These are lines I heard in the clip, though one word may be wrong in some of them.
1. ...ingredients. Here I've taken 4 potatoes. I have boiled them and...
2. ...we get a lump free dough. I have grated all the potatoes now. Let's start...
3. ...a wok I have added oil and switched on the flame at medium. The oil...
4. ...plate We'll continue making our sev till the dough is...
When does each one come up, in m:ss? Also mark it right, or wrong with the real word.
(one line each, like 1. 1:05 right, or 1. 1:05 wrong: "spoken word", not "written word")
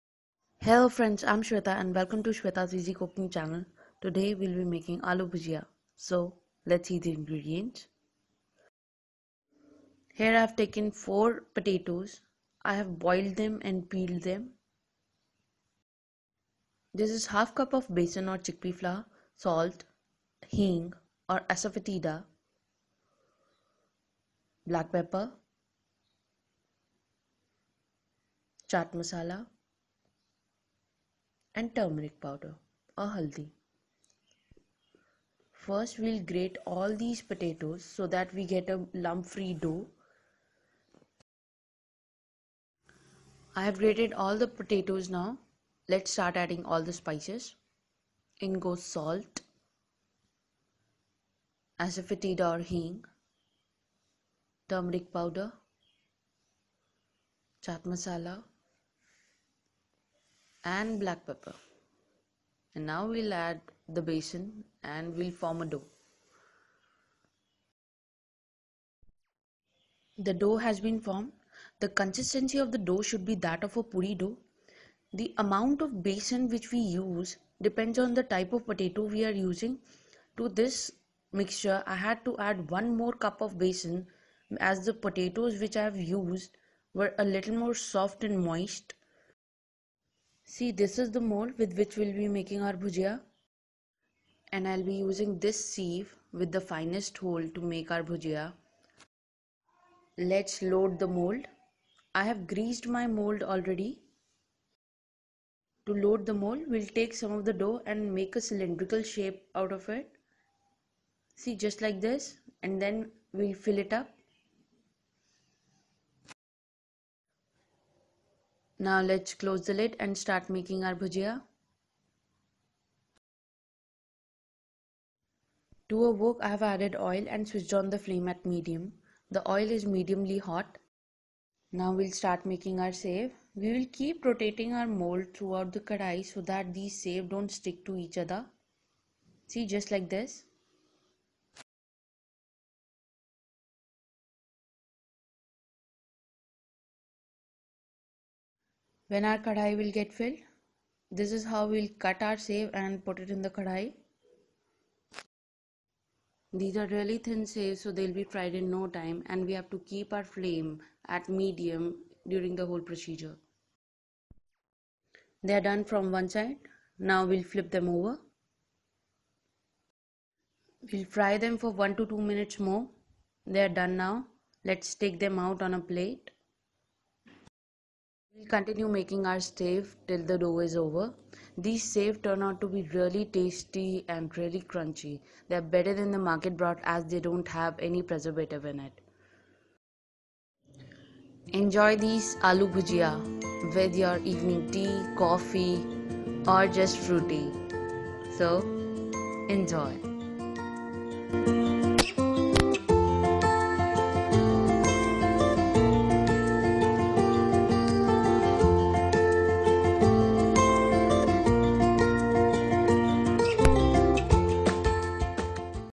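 1. 0:07 right
2. 0:38 right
3. 2:06 right
4. 2:55 right.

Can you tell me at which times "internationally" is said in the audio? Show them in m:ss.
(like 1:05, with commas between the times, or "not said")
not said.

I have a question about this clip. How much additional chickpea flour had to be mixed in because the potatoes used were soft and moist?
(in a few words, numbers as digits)
one more cup.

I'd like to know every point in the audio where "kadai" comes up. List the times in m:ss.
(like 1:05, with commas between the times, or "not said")
2:15, 2:29, 2:33.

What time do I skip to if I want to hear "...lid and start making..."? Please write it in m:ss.
1:59.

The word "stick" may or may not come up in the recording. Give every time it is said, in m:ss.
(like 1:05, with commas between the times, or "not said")
2:17.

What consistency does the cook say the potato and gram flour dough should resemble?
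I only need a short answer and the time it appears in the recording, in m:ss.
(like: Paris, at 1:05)
puri dough, at 1:13.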